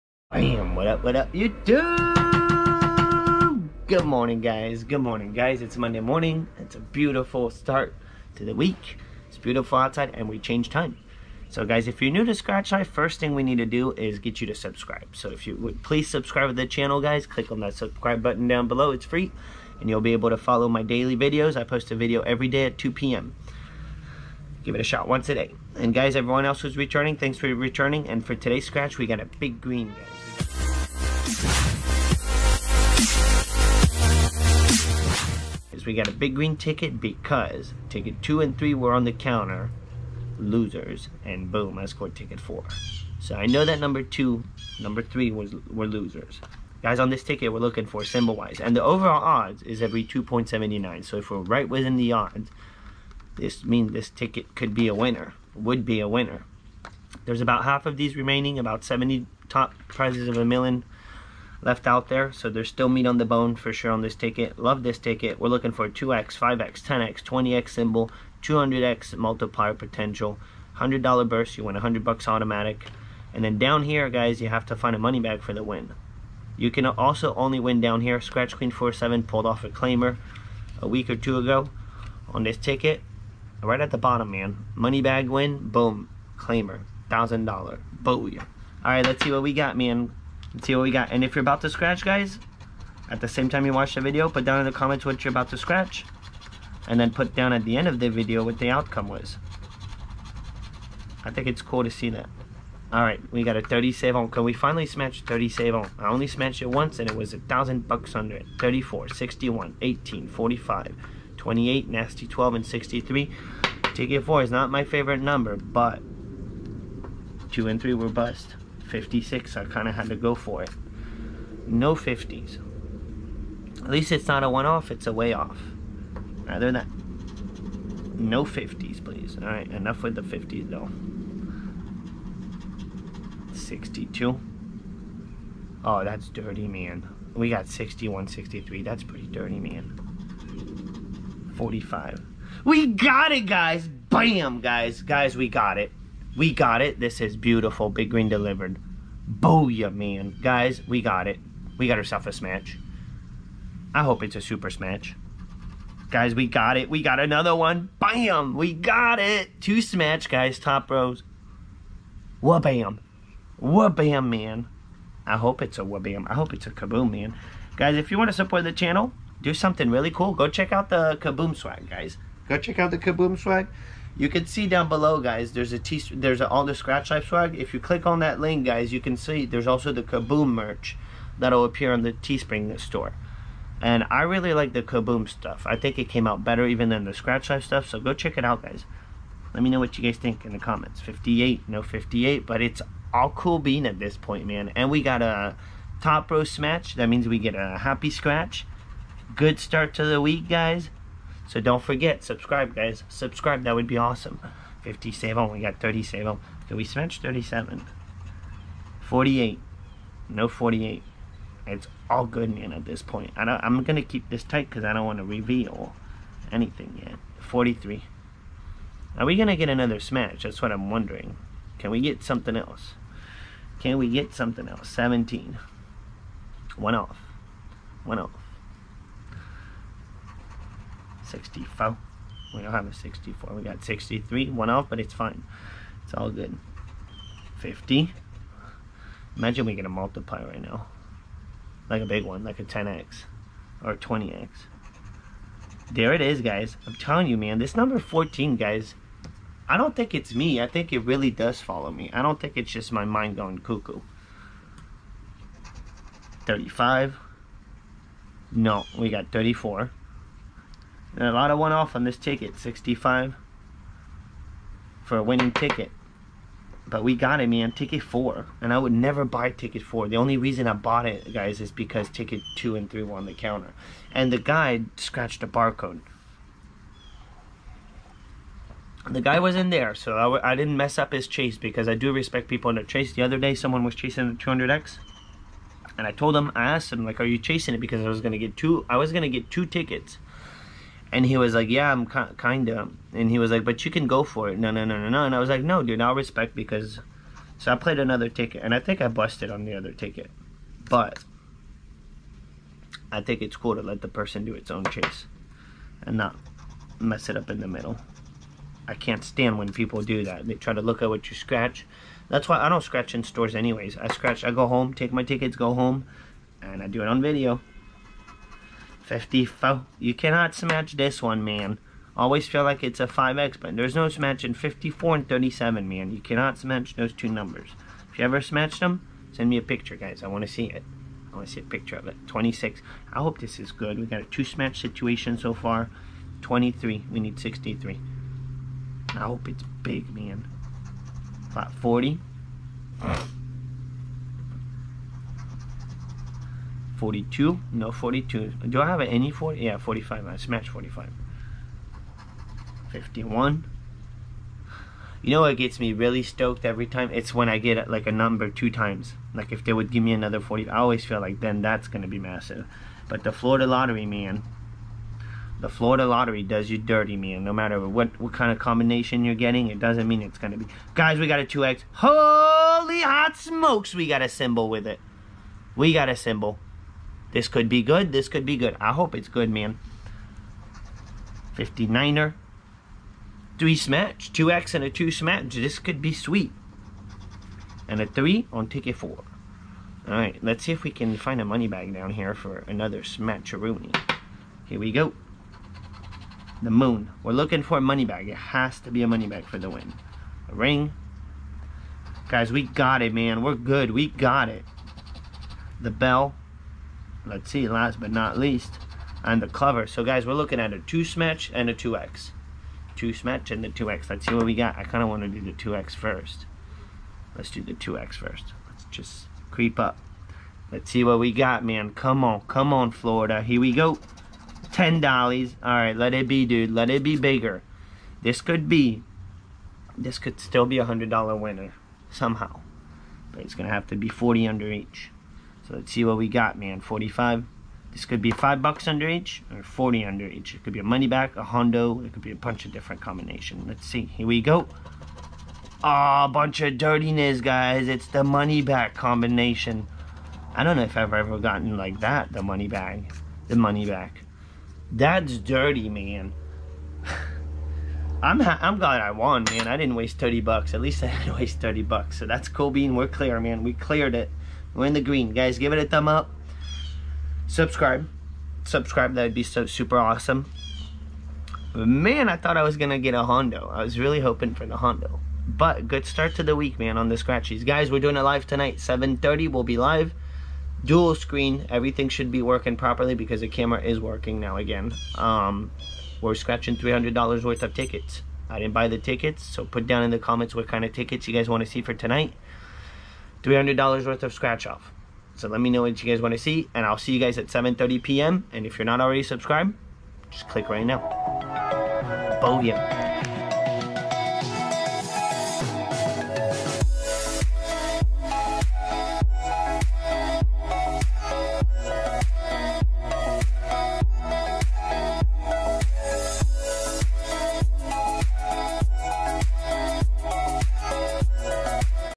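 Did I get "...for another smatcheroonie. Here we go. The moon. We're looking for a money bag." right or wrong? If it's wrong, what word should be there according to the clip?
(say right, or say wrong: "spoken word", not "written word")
right.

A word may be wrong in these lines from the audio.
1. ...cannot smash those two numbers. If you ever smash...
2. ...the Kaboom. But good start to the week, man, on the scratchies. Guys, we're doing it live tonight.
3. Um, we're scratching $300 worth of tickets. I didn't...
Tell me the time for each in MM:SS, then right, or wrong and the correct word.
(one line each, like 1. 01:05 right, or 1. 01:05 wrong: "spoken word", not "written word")
1. 05:26 right
2. 07:54 wrong: "Hondo", not "Kaboom"
3. 08:05 right.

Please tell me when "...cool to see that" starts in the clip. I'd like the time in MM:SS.
01:41.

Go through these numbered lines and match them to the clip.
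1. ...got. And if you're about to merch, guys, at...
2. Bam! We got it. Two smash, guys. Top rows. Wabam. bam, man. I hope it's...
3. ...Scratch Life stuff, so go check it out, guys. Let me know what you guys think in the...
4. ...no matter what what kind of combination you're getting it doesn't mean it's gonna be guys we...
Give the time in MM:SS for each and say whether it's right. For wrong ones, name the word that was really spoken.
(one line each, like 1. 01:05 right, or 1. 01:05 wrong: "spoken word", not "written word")
1. 01:30 wrong: "scratch", not "merch"
2. 02:37 right
3. 03:07 right
4. 06:07 right.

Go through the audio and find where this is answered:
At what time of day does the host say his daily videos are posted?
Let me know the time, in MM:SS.
00:22.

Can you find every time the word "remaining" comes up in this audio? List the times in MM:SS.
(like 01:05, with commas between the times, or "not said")
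00:58.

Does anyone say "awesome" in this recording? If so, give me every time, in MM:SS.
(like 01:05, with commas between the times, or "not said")
03:23, 07:49.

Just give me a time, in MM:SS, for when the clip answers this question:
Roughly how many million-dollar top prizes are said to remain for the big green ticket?
00:58.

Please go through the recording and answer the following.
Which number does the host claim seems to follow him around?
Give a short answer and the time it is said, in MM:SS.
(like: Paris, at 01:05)
14, at 04:07.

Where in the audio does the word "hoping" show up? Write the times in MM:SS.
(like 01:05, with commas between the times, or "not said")
07:54.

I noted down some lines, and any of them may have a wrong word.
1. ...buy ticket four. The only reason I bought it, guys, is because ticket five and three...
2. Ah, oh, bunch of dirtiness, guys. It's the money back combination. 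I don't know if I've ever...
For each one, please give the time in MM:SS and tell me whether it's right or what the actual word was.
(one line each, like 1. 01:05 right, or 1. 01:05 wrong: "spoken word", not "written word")
1. 04:29 wrong: "two", not "five"
2. 07:25 right.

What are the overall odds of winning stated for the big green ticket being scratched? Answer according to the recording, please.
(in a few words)
1 in 2.79.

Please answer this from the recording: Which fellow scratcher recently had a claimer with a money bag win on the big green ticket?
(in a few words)
Scratch Queen 47.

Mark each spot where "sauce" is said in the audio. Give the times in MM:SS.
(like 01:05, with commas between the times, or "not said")
not said.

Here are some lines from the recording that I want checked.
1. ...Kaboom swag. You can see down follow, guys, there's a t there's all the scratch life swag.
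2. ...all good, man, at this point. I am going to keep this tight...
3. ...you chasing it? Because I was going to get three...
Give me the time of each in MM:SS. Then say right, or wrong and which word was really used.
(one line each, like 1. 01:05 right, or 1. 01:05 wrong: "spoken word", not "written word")
1. 02:52 wrong: "below", not "follow"
2. 03:32 right
3. 04:47 wrong: "two", not "three".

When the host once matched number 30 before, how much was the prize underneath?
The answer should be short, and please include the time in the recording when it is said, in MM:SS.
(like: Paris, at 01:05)
$1,000, at 01:47.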